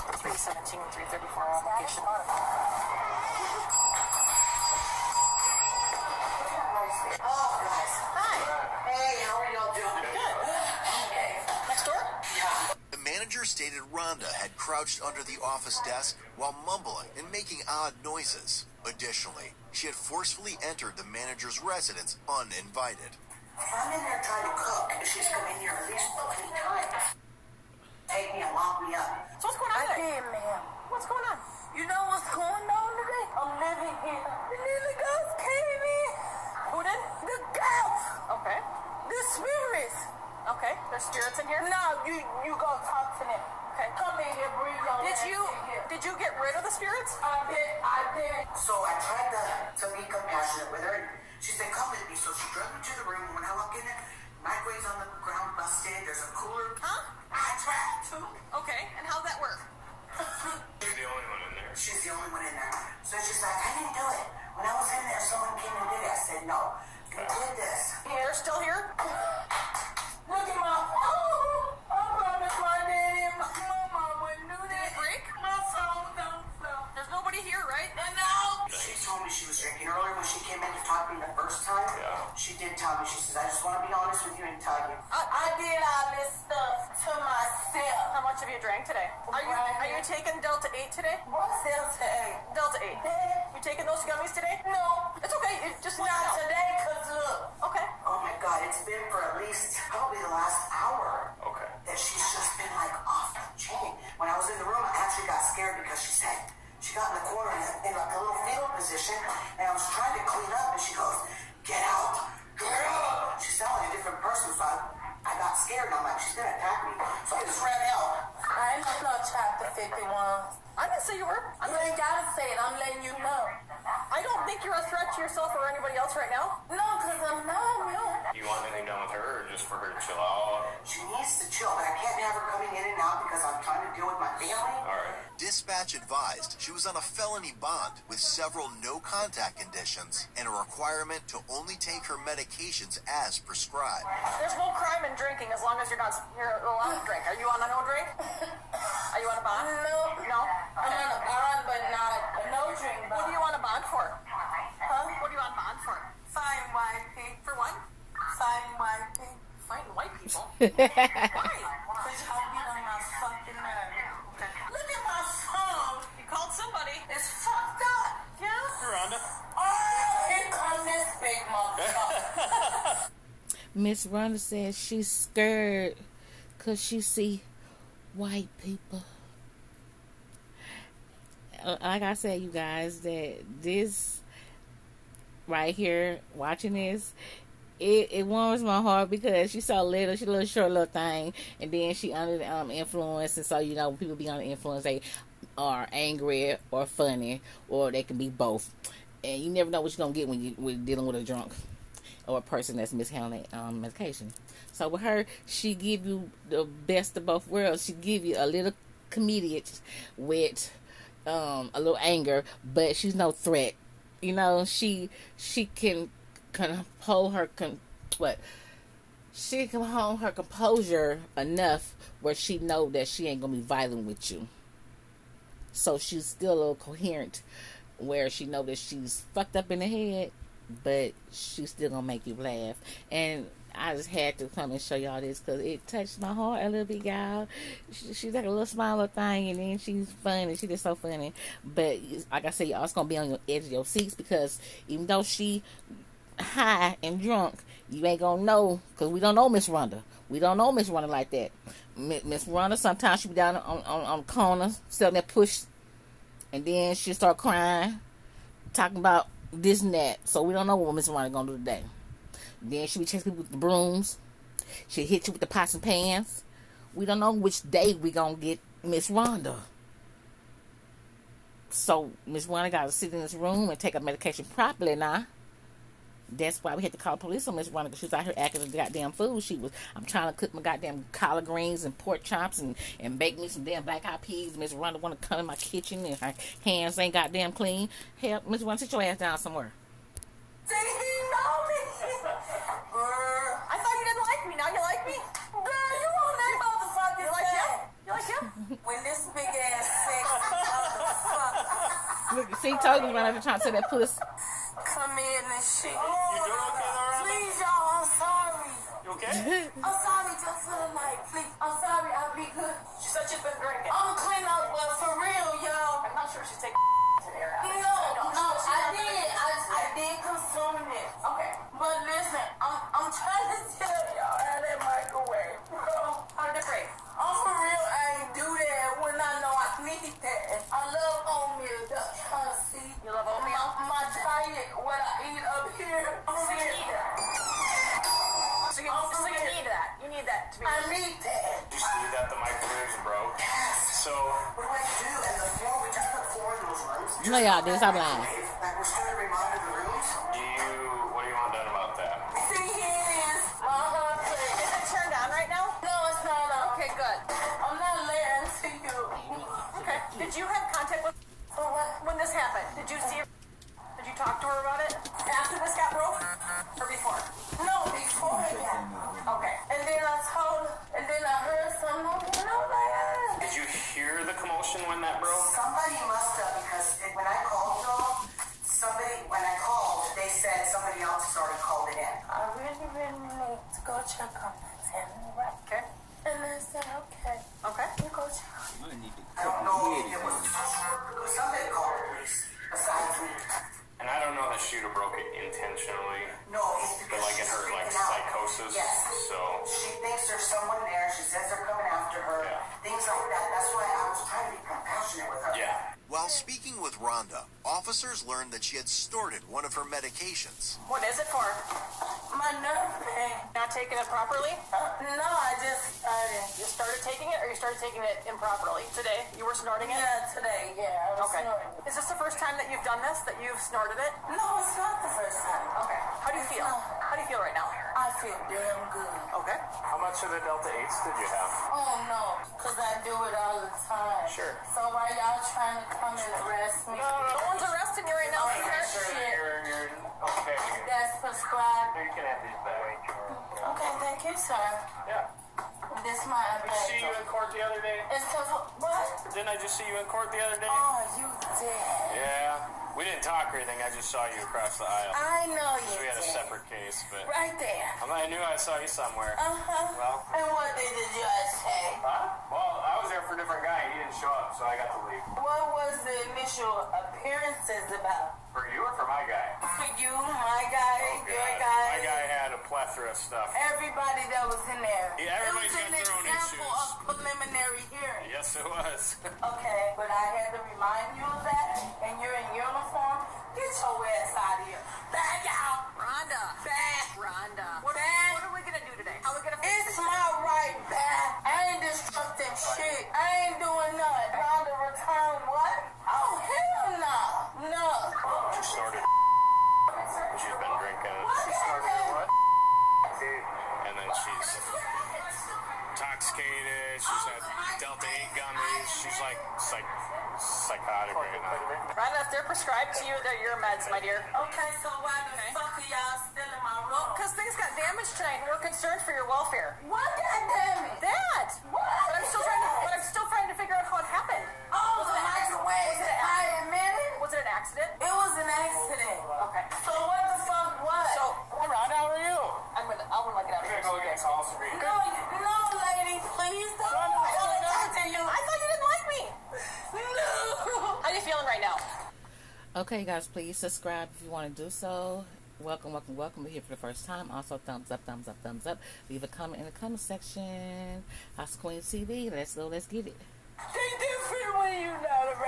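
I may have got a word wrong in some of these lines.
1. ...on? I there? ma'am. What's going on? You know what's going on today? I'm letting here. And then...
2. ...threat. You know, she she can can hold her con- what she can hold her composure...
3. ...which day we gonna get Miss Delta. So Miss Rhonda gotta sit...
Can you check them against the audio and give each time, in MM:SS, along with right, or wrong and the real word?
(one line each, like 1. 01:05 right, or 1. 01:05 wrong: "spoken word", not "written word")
1. 00:29 wrong: "living", not "letting"
2. 03:33 right
3. 04:27 wrong: "Rhonda", not "Delta".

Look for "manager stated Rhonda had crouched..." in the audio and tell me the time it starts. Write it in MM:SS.
00:13.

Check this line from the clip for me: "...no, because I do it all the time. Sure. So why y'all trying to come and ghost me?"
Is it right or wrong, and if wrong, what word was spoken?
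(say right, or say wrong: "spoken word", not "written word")
wrong: "arrest", not "ghost".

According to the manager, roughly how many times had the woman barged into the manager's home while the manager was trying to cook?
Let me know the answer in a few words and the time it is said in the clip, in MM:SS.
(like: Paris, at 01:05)
15, at 00:26.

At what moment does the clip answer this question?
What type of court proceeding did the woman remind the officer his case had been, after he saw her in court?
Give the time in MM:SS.
07:57.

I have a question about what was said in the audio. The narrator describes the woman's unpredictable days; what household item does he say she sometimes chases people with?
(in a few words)
brooms.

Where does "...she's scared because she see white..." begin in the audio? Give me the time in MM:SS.
02:54.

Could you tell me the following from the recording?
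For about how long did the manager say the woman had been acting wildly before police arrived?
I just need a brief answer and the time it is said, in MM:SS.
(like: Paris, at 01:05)
the last hour, at 01:40.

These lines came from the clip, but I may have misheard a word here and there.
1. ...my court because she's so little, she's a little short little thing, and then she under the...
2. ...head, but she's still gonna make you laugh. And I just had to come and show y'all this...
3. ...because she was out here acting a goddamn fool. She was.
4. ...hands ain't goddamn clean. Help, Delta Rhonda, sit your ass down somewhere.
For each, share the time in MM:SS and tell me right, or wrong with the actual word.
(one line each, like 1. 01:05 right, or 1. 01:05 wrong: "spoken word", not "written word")
1. 03:08 wrong: "heart", not "court"
2. 03:49 right
3. 04:37 right
4. 04:46 wrong: "Miss", not "Delta".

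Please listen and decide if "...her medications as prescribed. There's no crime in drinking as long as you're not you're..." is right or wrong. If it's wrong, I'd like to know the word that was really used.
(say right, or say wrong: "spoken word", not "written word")
right.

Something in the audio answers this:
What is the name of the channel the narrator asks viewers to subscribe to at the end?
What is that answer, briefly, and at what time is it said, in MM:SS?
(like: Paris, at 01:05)
House Queen TV, at 09:11.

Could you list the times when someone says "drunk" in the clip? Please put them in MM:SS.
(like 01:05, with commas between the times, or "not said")
03:21, 04:07.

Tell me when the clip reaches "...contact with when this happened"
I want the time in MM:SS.
06:00.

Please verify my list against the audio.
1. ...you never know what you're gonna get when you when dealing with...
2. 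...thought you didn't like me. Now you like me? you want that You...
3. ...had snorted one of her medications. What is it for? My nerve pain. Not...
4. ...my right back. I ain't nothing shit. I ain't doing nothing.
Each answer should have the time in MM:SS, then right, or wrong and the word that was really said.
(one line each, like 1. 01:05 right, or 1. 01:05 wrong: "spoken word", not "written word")
1. 03:19 right
2. 04:53 right
3. 06:48 right
4. 08:09 wrong: "destructing", not "nothing".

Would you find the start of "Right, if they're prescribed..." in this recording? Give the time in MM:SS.
08:31.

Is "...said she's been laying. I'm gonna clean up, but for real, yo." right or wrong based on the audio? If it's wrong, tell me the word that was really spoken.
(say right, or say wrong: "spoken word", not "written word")
wrong: "drinking", not "laying".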